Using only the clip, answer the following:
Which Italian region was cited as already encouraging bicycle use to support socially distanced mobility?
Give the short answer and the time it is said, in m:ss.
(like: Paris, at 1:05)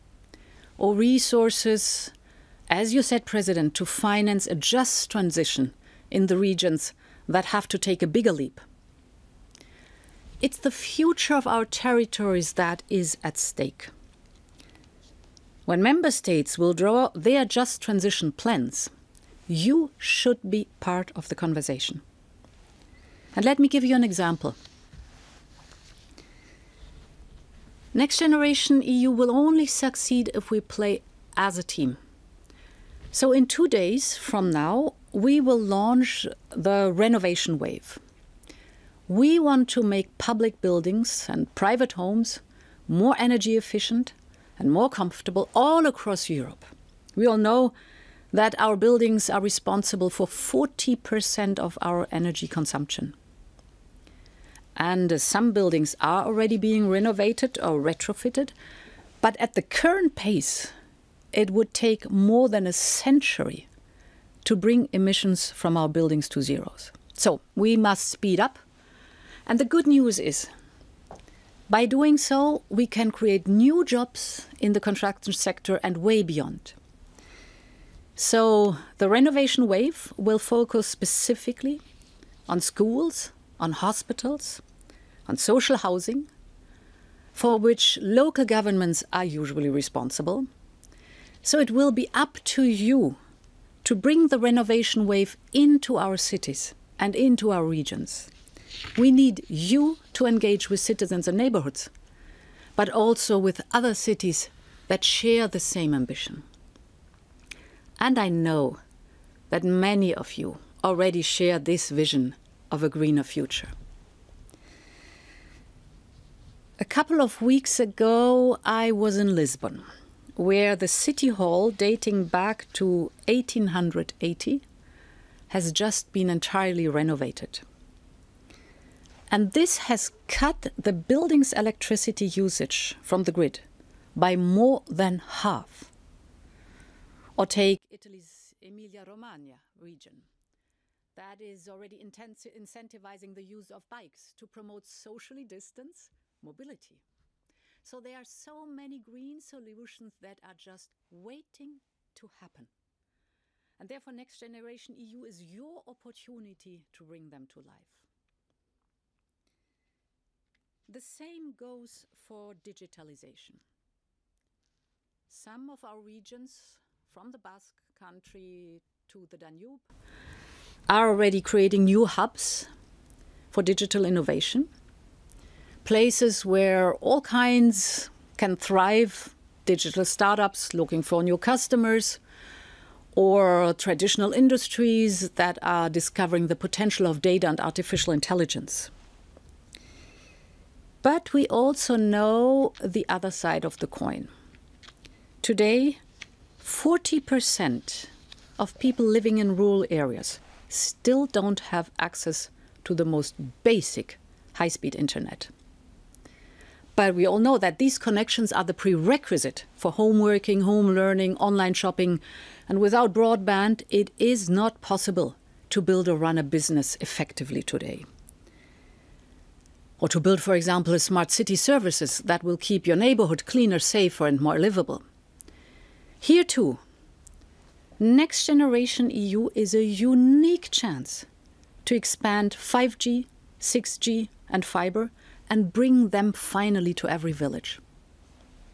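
Emilia Romagna, at 2:18.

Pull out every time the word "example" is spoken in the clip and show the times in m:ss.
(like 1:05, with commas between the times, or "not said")
0:24, 3:40.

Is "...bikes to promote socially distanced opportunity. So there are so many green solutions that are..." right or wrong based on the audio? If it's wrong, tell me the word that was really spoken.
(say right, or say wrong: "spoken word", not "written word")
wrong: "mobility", not "opportunity".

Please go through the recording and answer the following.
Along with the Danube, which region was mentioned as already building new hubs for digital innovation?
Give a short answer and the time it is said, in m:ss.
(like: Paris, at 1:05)
Basque country, at 2:47.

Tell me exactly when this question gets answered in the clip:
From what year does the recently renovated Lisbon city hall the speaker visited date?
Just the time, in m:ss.
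2:03.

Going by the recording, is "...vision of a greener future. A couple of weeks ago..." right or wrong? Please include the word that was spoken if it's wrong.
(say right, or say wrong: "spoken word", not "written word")
right.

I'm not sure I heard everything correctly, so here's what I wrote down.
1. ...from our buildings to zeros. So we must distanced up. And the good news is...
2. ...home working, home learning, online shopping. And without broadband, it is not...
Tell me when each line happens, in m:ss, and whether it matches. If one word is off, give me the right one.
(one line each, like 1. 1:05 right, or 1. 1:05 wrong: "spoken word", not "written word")
1. 1:05 wrong: "speed", not "distanced"
2. 3:29 right.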